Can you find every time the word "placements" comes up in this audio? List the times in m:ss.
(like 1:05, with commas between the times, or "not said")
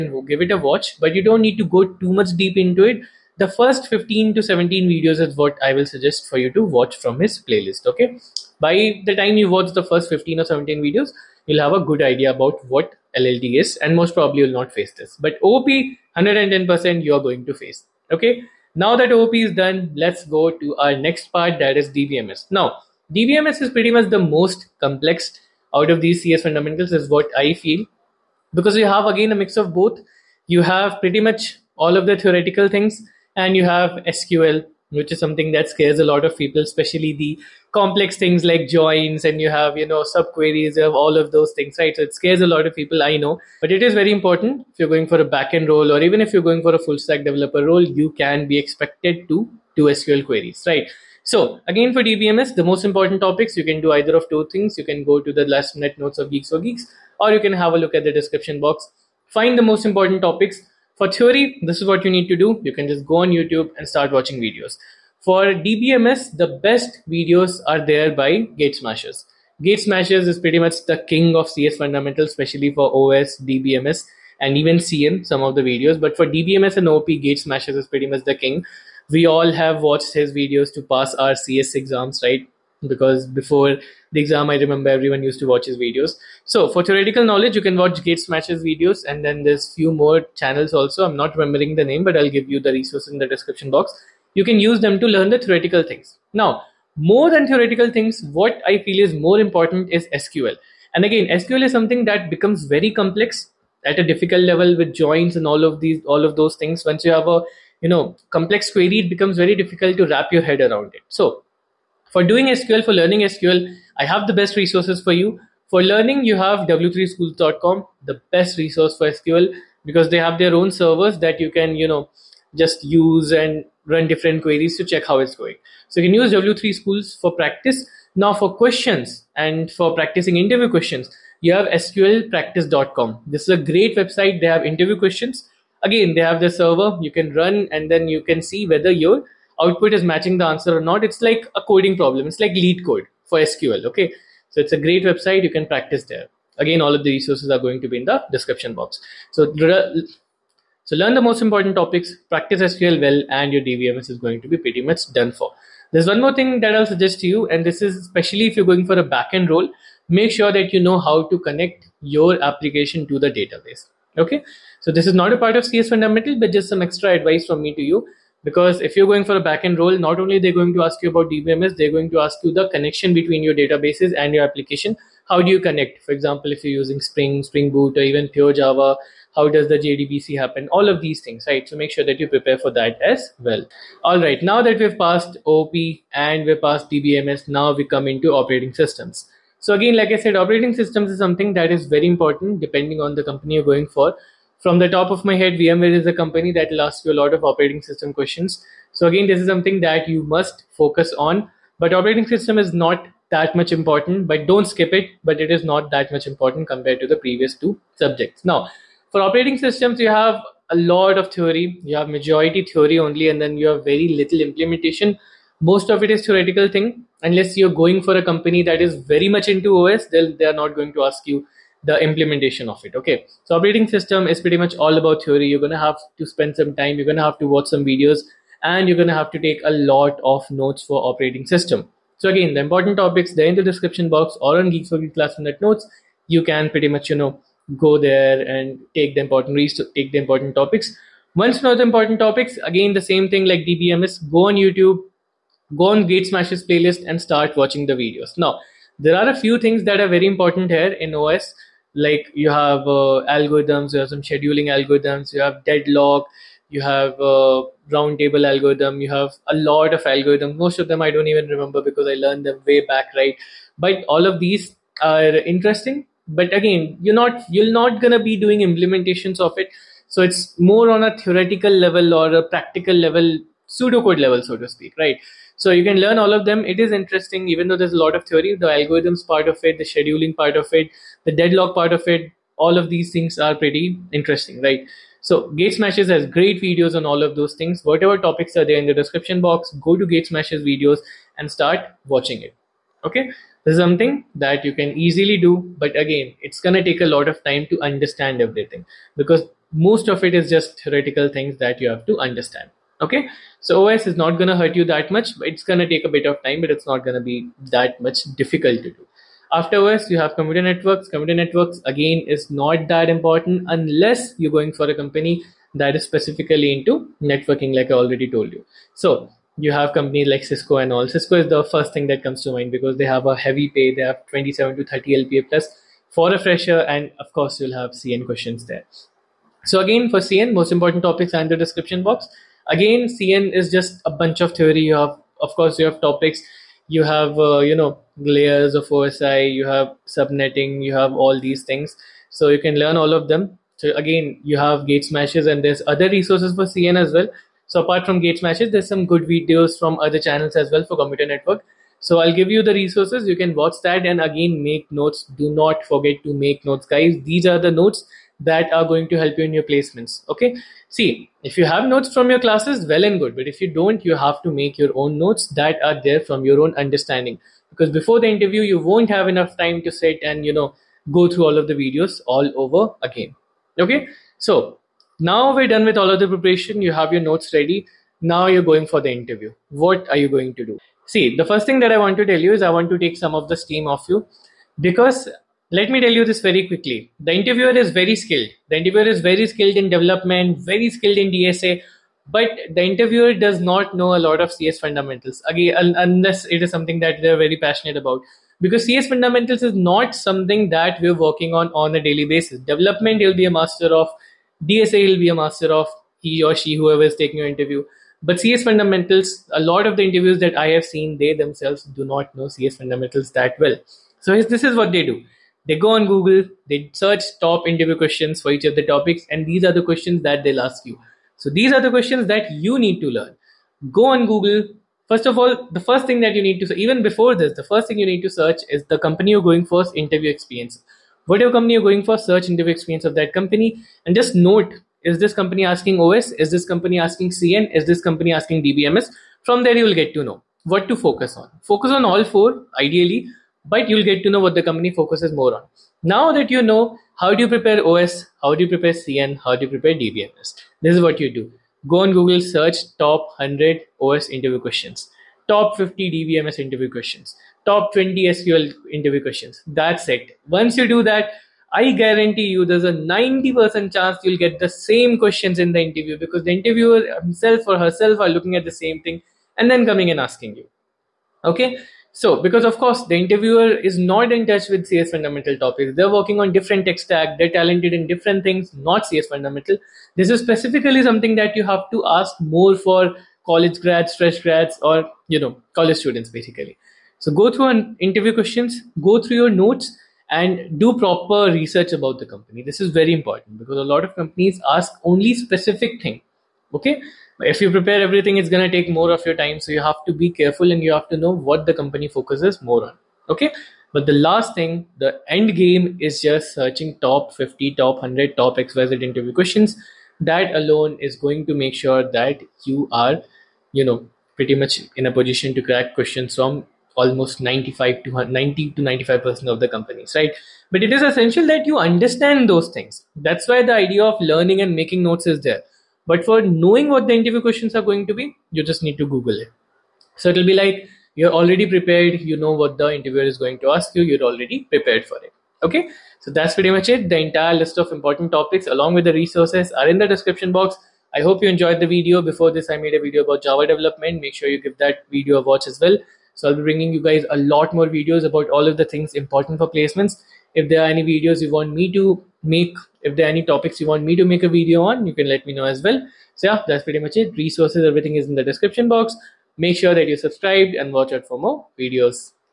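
5:59, 9:09.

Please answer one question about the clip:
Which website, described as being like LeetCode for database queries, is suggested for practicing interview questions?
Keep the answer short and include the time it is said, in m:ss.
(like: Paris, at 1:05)
sqlpractice.com, at 2:11.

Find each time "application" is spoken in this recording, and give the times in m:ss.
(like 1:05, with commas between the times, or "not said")
2:42, 2:54.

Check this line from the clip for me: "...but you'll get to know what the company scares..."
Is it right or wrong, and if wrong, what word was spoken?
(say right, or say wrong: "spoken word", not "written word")
wrong: "focuses", not "scares".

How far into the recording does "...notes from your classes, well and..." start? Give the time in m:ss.
6:01.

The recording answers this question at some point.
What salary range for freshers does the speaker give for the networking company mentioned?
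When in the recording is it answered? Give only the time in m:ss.
5:24.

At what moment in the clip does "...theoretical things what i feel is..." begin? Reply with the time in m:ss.
1:37.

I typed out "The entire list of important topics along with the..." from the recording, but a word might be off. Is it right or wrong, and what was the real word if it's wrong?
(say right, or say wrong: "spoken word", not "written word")
right.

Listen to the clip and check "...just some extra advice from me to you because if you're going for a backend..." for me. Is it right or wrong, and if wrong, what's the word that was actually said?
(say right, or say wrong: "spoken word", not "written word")
right.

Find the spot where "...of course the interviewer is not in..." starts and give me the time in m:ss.
7:52.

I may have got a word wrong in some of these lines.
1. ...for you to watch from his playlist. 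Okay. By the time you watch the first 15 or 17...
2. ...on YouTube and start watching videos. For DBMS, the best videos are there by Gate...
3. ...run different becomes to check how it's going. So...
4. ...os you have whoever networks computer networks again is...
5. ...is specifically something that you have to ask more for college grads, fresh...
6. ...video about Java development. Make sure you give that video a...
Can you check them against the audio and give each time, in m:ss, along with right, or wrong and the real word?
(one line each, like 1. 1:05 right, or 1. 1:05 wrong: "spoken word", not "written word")
1. 0:06 right
2. 1:03 right
3. 2:03 wrong: "queries", not "becomes"
4. 5:09 wrong: "computer", not "whoever"
5. 8:00 right
6. 9:02 right.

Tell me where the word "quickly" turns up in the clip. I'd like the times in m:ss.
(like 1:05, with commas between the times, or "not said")
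6:26.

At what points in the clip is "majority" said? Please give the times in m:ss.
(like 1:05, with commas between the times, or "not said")
3:32.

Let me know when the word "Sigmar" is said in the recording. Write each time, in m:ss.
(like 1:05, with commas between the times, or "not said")
not said.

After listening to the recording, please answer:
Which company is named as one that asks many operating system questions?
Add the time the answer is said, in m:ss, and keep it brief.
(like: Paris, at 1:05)
VMware, at 3:15.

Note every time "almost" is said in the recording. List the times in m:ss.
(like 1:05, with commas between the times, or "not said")
8:36.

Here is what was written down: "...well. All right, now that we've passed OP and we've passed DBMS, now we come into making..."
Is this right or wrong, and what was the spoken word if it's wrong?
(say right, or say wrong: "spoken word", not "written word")
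wrong: "operating", not "making".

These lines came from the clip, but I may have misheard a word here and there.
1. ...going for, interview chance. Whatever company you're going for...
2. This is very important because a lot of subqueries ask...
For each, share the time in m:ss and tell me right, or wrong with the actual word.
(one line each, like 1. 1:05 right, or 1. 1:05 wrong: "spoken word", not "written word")
1. 7:09 wrong: "experience", not "chance"
2. 8:12 wrong: "companies", not "subqueries".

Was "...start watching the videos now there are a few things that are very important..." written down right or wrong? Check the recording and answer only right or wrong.
right.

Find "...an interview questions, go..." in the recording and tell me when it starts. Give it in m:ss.
8:07.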